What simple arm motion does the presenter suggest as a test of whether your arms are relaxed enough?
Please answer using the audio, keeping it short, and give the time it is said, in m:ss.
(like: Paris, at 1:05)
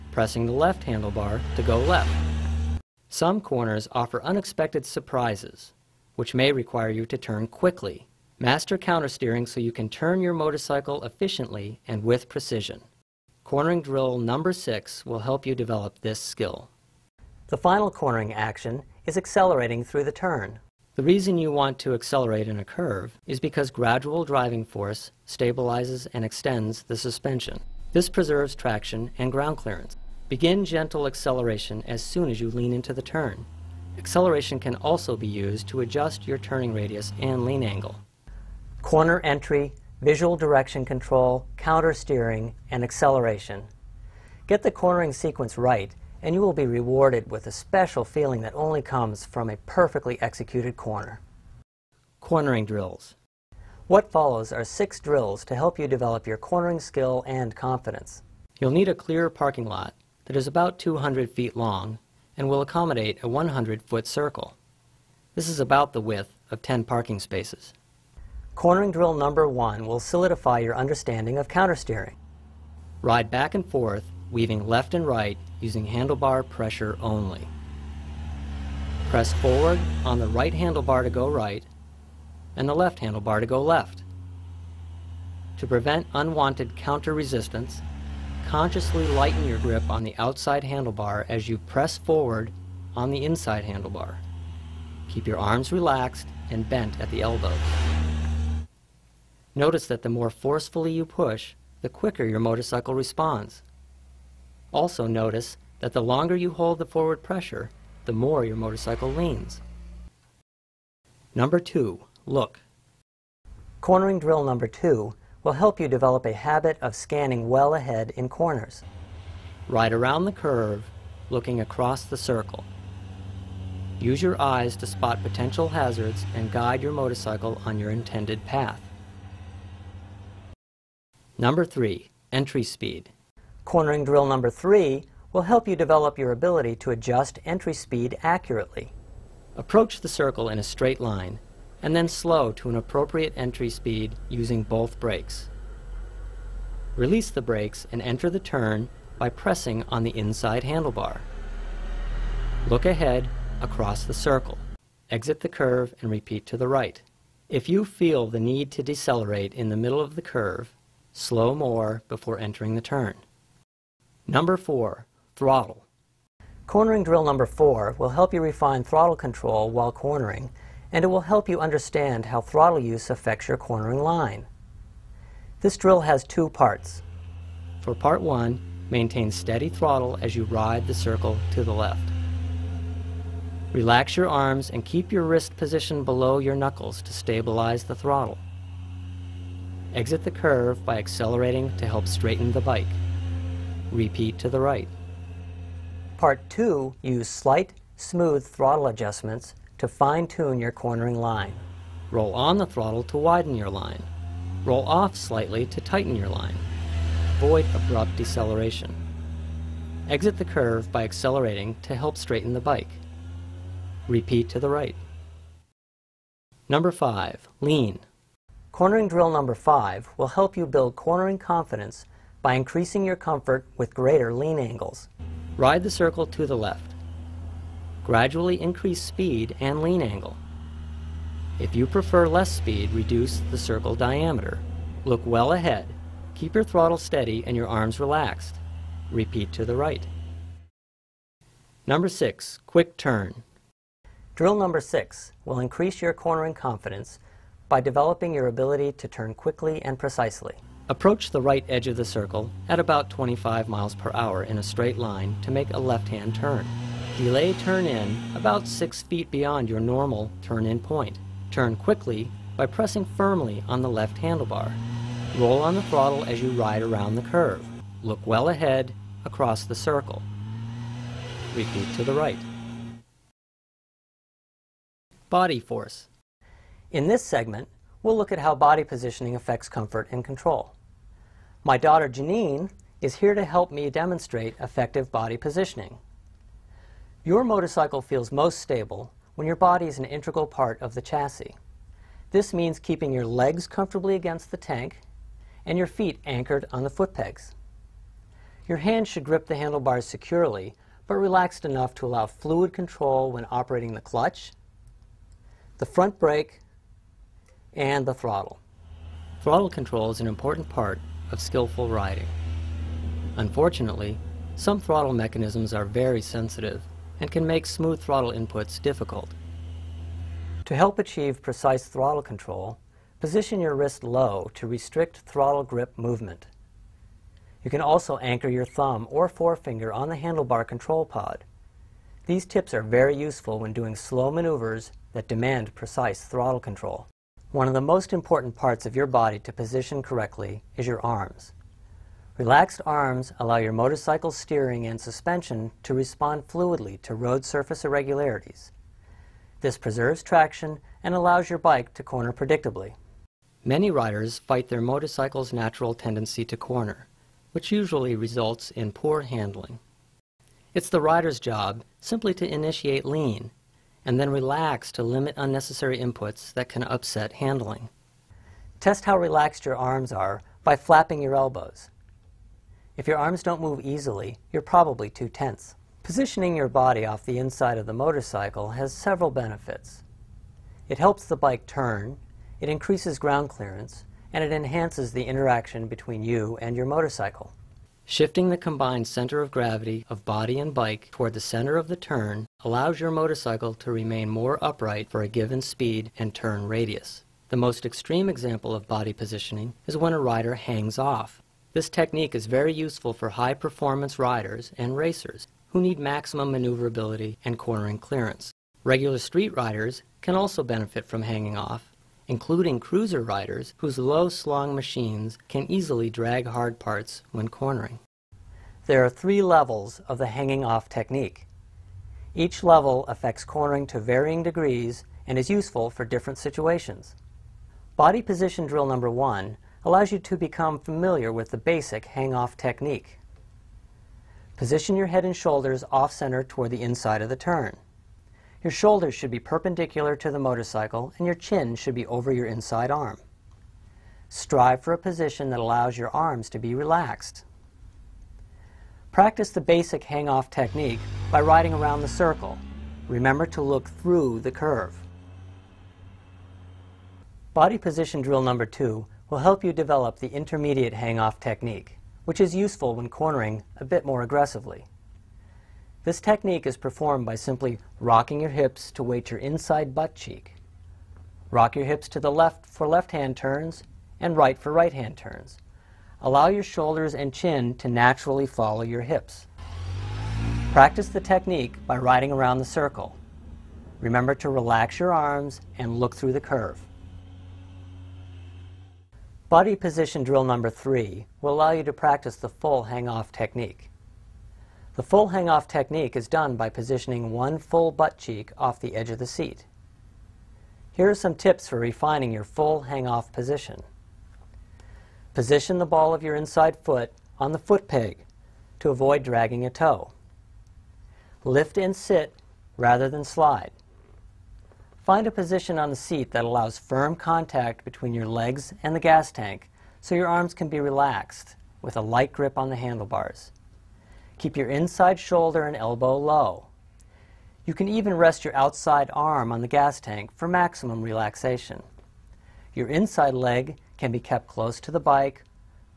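Flapping your elbows, at 6:10.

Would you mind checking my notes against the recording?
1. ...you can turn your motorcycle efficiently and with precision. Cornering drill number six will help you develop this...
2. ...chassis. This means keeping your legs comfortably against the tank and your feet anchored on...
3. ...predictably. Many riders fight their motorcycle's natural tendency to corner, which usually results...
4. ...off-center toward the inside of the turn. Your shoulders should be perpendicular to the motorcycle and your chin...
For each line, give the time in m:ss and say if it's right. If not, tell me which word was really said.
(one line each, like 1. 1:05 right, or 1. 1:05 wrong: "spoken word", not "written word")
1. 0:09 right
2. 4:51 right
3. 5:52 right
4. 7:15 right.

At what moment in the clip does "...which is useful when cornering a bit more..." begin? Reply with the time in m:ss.
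7:42.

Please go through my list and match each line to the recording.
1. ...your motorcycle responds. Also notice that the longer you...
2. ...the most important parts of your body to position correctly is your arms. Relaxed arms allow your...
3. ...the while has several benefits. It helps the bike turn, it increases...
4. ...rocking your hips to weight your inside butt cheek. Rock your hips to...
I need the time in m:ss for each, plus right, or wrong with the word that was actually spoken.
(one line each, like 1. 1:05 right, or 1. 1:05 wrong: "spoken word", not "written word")
1. 1:42 right
2. 5:37 right
3. 6:17 wrong: "motorcycle", not "while"
4. 7:47 right.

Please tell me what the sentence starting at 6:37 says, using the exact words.
The most extreme example of body positioning is when a rider hangs off.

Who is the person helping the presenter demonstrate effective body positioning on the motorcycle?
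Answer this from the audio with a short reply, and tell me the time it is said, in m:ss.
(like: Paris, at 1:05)
Janine, at 4:42.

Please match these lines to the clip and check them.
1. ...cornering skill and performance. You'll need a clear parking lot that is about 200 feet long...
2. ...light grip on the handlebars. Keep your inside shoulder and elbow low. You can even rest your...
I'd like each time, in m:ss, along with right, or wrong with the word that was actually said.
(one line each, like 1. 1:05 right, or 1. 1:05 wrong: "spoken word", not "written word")
1. 0:56 wrong: "confidence", not "performance"
2. 8:42 right.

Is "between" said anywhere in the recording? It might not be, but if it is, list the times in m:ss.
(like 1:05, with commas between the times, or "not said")
6:25, 8:37.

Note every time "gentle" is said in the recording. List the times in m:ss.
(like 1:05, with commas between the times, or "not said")
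0:30.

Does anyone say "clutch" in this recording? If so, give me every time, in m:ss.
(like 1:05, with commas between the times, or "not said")
5:04.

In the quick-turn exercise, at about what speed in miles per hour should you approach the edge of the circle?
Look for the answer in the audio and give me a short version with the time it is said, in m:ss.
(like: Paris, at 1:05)
25, at 4:13.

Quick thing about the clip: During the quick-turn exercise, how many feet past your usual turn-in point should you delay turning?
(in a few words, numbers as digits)
6.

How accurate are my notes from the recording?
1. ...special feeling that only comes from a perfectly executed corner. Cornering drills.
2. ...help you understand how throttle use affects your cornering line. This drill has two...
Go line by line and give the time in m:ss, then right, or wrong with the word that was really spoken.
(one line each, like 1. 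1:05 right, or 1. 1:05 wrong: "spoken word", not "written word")
1. 0:47 right
2. 2:51 right.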